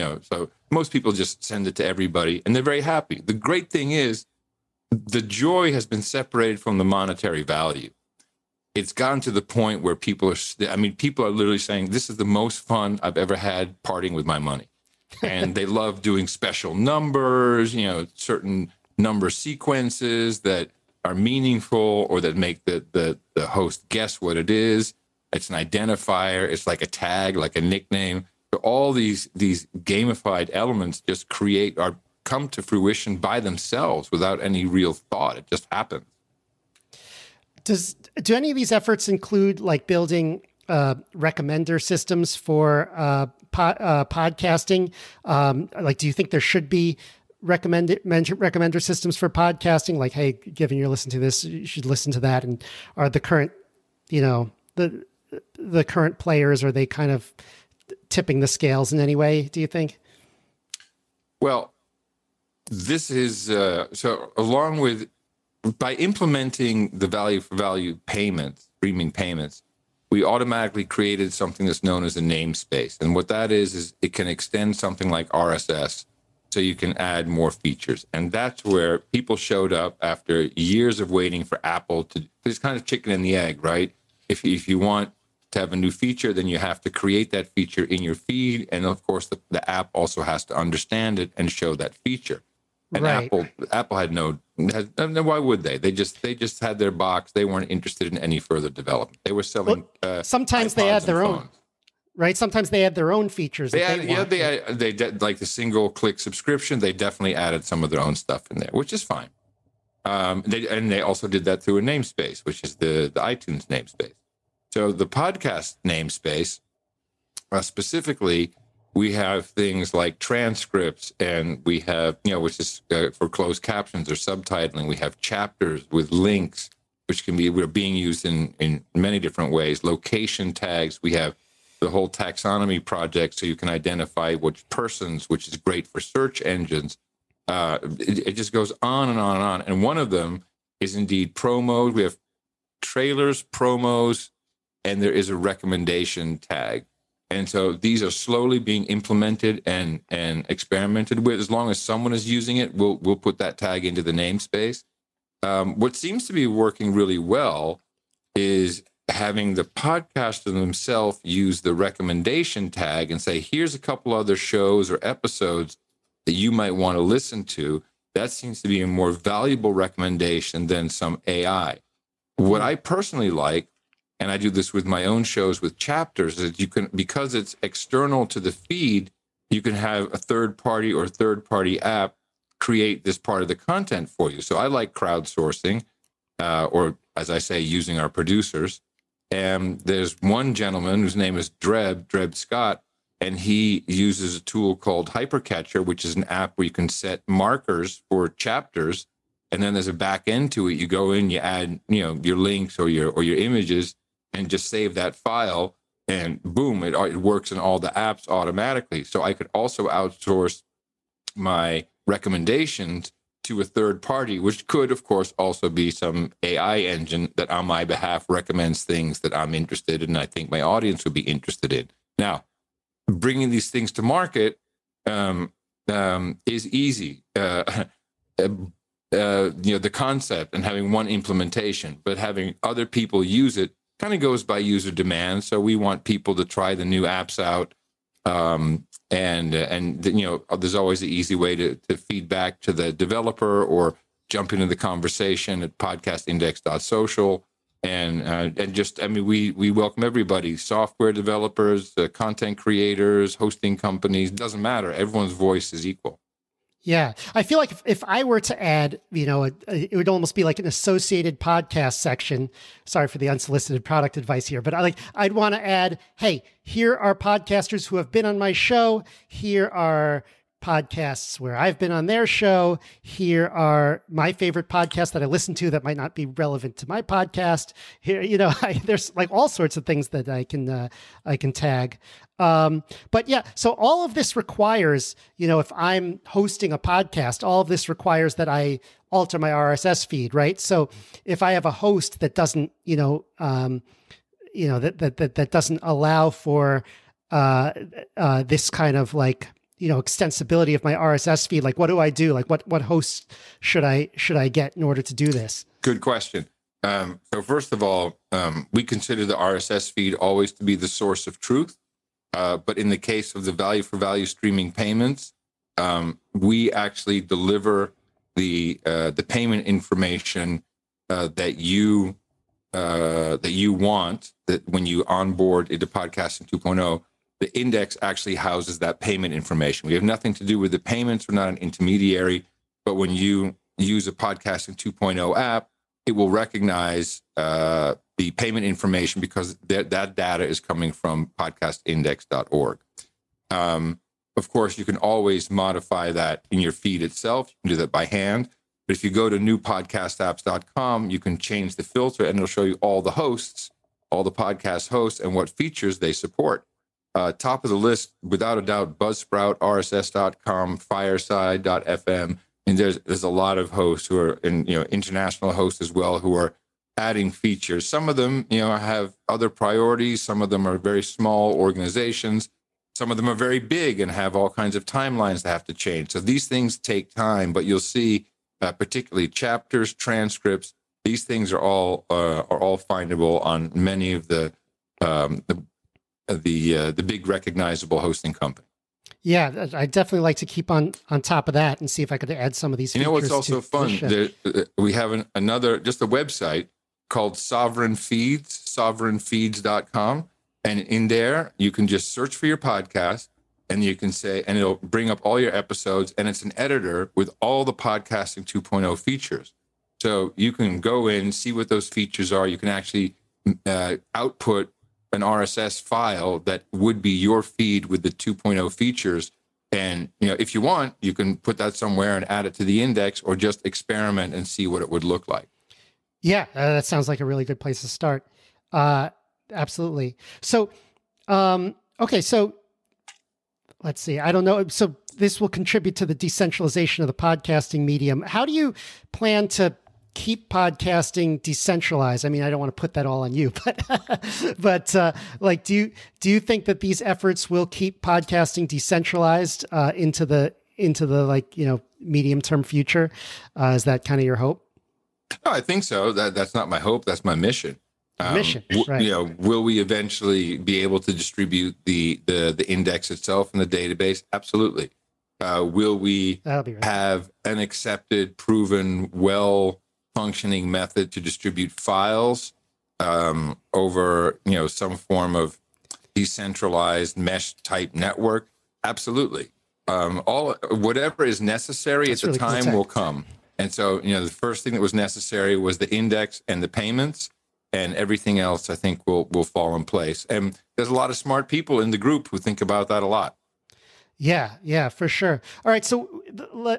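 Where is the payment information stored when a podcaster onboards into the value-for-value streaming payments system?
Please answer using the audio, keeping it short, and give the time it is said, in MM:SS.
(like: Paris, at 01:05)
podcastindex.org, at 05:41.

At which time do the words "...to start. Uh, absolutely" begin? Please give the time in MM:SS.
07:07.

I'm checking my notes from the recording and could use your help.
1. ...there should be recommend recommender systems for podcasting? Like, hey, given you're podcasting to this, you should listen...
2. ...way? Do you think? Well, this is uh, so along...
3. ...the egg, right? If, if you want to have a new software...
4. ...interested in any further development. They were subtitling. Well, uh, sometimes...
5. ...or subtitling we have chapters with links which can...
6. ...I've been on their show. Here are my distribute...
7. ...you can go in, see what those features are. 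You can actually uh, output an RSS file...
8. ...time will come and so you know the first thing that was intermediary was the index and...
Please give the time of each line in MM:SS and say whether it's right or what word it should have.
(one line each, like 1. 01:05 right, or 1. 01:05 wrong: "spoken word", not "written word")
1. 00:46 wrong: "listening", not "podcasting"
2. 00:59 right
3. 01:23 wrong: "feature", not "software"
4. 01:37 wrong: "selling", not "subtitling"
5. 02:04 right
6. 04:31 wrong: "favorite", not "distribute"
7. 06:50 right
8. 08:02 wrong: "necessary", not "intermediary".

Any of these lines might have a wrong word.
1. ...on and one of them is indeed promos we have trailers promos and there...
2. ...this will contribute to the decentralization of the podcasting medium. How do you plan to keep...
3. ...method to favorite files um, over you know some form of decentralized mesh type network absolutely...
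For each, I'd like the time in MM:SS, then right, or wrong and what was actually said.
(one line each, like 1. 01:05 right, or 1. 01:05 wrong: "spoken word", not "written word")
1. 02:19 right
2. 07:15 right
3. 07:50 wrong: "distribute", not "favorite".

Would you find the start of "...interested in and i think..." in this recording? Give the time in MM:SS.
03:39.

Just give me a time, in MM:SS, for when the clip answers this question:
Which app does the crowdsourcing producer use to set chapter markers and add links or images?
03:15.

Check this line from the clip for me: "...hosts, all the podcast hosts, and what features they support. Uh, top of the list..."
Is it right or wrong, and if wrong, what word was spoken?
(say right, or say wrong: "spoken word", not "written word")
right.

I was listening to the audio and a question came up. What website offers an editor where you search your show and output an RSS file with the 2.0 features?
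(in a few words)
sovereignfeeds.com.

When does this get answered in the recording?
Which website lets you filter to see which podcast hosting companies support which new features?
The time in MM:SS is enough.
05:49.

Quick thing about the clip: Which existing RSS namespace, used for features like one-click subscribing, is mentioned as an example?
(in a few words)
iTunes namespace.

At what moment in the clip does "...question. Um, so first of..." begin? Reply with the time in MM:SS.
05:06.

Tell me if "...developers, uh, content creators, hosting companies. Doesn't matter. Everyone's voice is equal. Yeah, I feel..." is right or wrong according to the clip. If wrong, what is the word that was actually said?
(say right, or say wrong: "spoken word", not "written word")
right.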